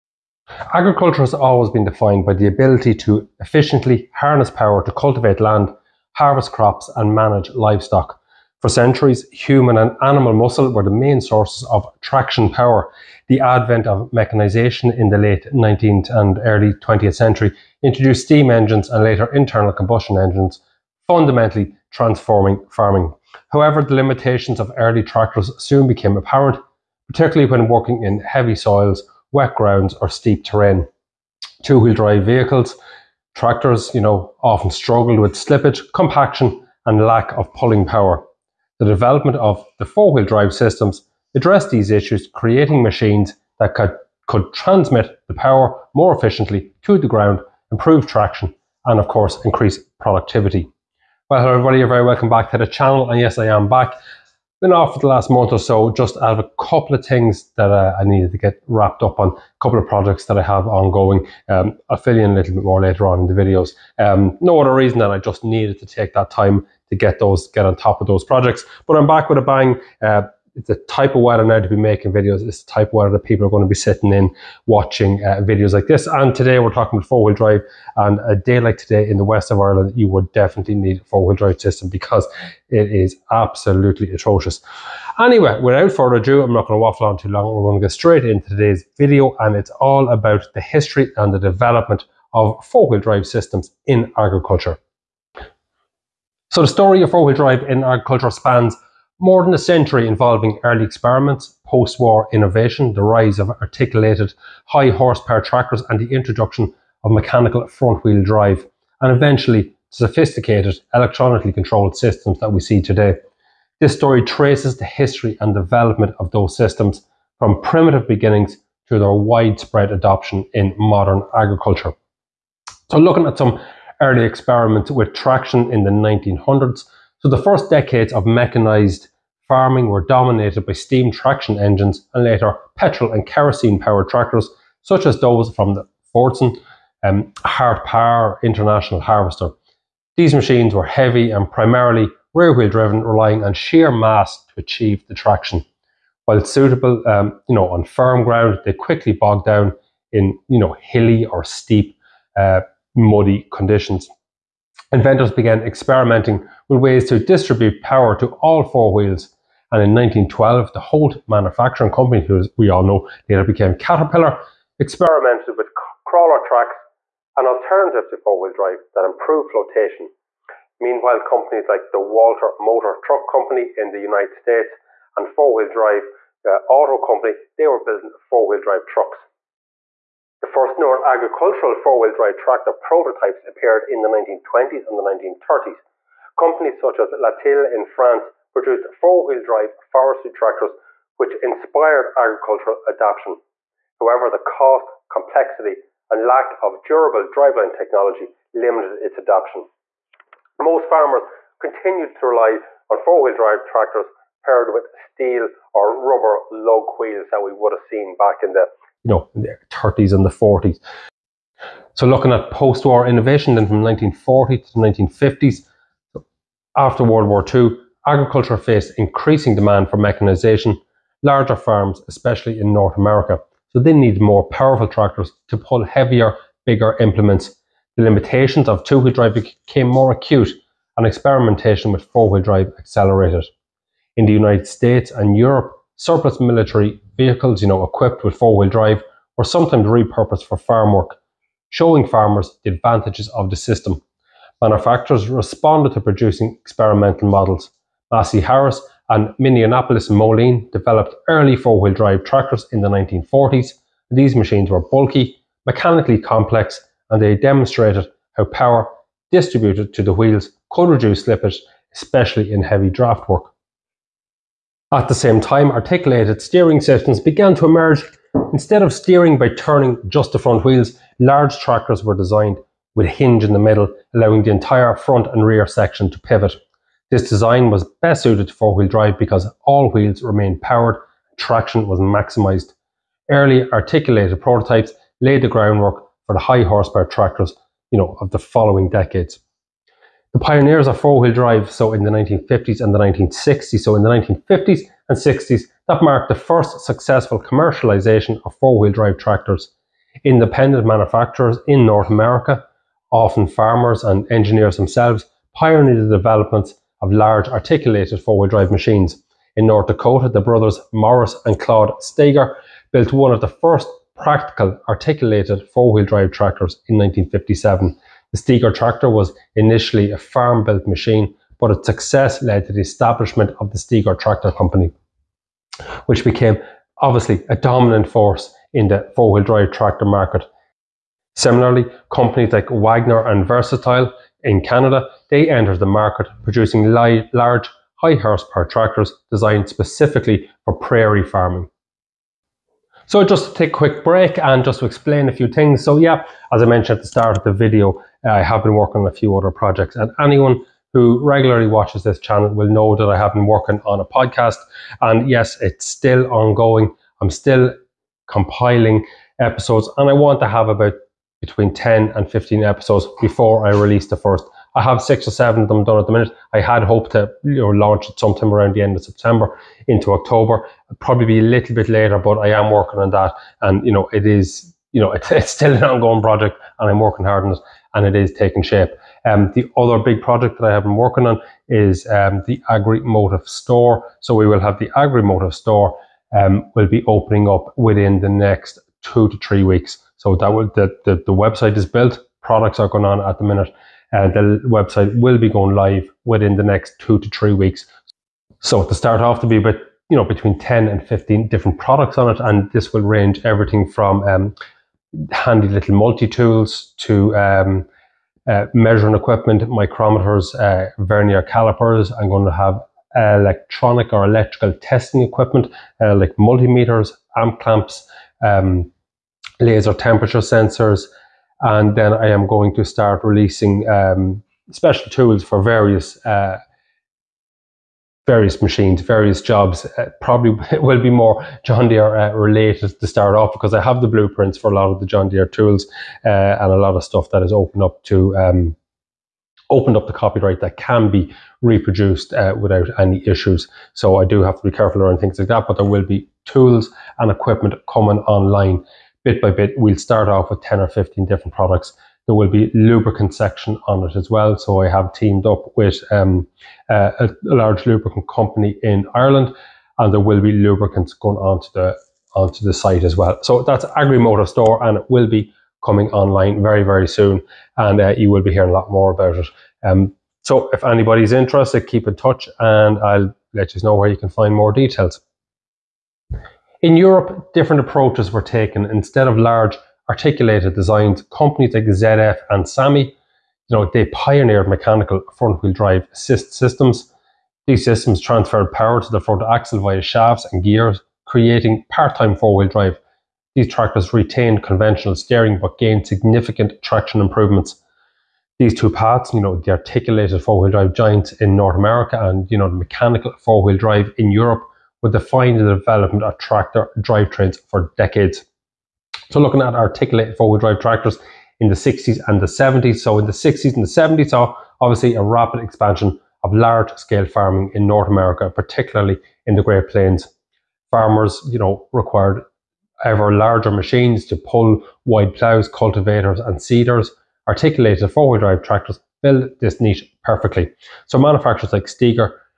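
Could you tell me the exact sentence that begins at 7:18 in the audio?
Um, opened up the copyright that can be reproduced uh, without any issues.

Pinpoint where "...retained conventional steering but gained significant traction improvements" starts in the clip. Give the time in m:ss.
8:14.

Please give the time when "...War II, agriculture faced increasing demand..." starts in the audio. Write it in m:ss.
3:37.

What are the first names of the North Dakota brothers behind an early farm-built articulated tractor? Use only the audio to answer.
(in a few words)
Morris and Claude.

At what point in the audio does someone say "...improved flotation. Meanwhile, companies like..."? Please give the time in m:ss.
2:49.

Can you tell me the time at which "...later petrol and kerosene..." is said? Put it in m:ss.
2:12.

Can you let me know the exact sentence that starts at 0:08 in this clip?
For centuries, human and animal muscle were the main sources of traction power.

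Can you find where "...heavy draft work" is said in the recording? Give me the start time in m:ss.
4:22.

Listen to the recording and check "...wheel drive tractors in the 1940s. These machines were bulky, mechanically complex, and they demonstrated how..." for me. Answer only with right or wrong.
right.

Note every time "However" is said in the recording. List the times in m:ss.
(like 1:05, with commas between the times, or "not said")
0:23, 3:13.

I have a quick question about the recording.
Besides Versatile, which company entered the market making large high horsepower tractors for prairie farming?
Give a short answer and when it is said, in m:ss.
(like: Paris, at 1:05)
Wagner, at 5:32.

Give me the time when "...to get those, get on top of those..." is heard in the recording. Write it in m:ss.
1:06.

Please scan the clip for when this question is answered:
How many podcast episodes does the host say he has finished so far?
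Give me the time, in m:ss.
6:05.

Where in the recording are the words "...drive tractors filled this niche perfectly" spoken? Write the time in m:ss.
8:48.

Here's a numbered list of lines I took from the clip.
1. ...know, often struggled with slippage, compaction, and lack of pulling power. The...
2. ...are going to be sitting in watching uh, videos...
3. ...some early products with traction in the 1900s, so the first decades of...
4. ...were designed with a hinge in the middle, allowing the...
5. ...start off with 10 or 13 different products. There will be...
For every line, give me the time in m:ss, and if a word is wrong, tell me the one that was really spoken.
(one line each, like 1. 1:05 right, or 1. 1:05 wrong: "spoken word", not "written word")
1. 0:34 right
2. 1:13 right
3. 2:03 wrong: "experiments", not "products"
4. 4:32 right
5. 7:29 wrong: "15", not "13".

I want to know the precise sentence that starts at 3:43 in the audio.
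So they need more powerful tractors to pull heavier, bigger implements.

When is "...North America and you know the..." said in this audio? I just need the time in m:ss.
8:21.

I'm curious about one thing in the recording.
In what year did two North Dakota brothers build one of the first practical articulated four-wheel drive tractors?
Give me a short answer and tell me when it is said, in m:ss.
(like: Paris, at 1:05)
1957, at 5:16.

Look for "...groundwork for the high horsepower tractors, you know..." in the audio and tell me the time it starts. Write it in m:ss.
4:45.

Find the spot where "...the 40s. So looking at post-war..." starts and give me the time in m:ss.
3:30.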